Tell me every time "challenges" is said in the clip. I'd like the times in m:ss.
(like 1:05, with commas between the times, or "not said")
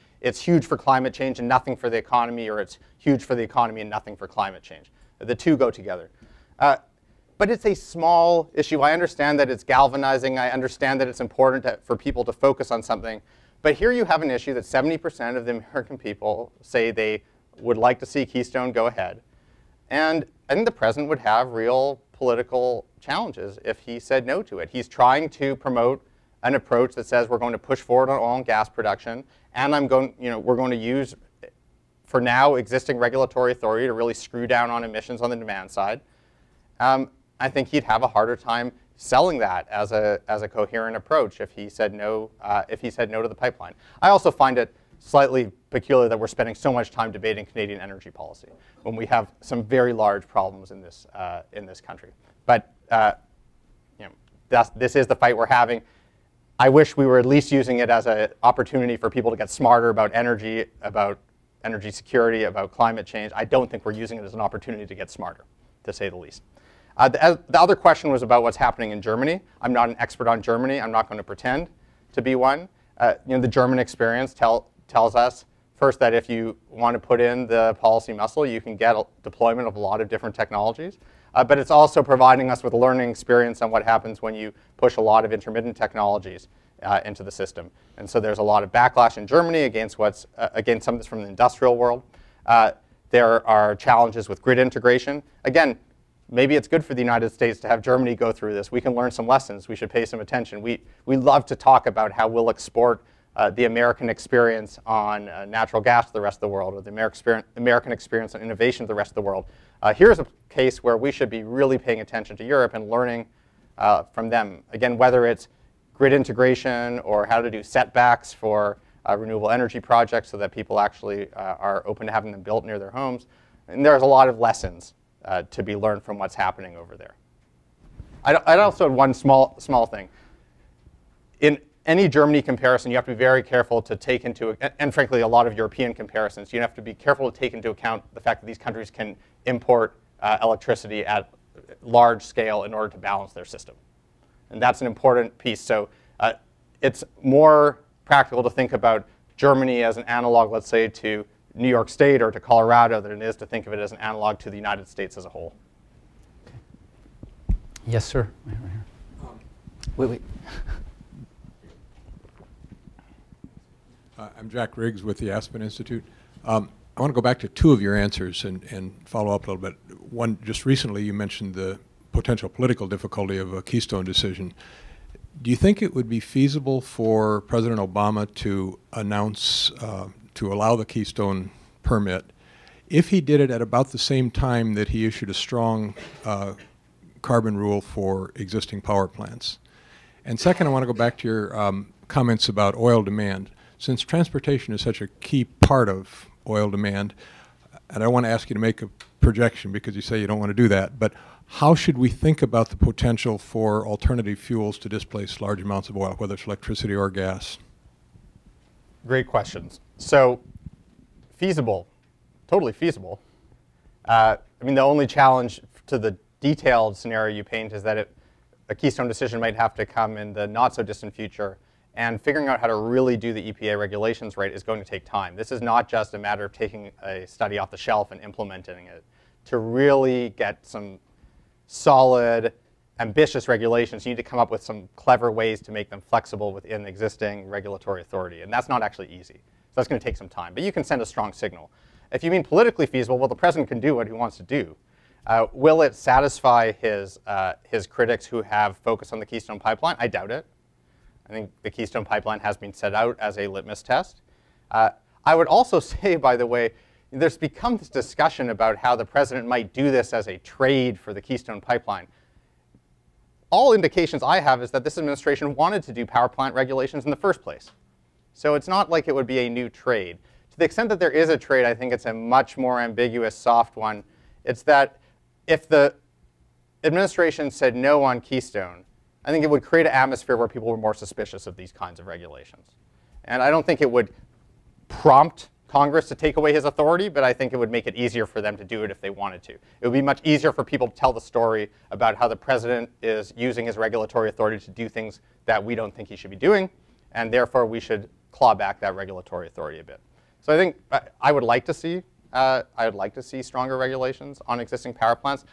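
0:23, 1:33, 3:35.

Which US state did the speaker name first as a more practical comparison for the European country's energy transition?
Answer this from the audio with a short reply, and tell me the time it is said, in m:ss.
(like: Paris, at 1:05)
New York State, at 2:31.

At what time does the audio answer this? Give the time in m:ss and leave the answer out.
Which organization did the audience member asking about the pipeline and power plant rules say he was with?
2:45.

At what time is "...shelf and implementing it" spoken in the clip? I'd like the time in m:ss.
3:47.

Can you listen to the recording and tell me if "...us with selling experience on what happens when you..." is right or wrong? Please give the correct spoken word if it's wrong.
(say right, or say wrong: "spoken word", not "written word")
wrong: "learning", not "selling".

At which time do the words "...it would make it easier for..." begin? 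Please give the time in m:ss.
4:47.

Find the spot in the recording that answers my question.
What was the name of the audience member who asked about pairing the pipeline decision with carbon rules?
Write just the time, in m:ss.
2:44.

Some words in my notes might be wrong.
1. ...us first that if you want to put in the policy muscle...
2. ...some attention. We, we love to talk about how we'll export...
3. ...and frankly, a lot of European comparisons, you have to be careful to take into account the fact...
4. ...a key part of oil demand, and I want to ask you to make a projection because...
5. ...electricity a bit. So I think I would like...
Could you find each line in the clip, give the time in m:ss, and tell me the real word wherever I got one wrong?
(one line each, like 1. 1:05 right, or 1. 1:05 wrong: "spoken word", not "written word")
1. 1:15 right
2. 1:40 right
3. 2:14 right
4. 3:15 right
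5. 4:59 wrong: "authority", not "electricity".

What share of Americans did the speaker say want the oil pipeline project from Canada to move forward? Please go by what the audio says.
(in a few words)
70%.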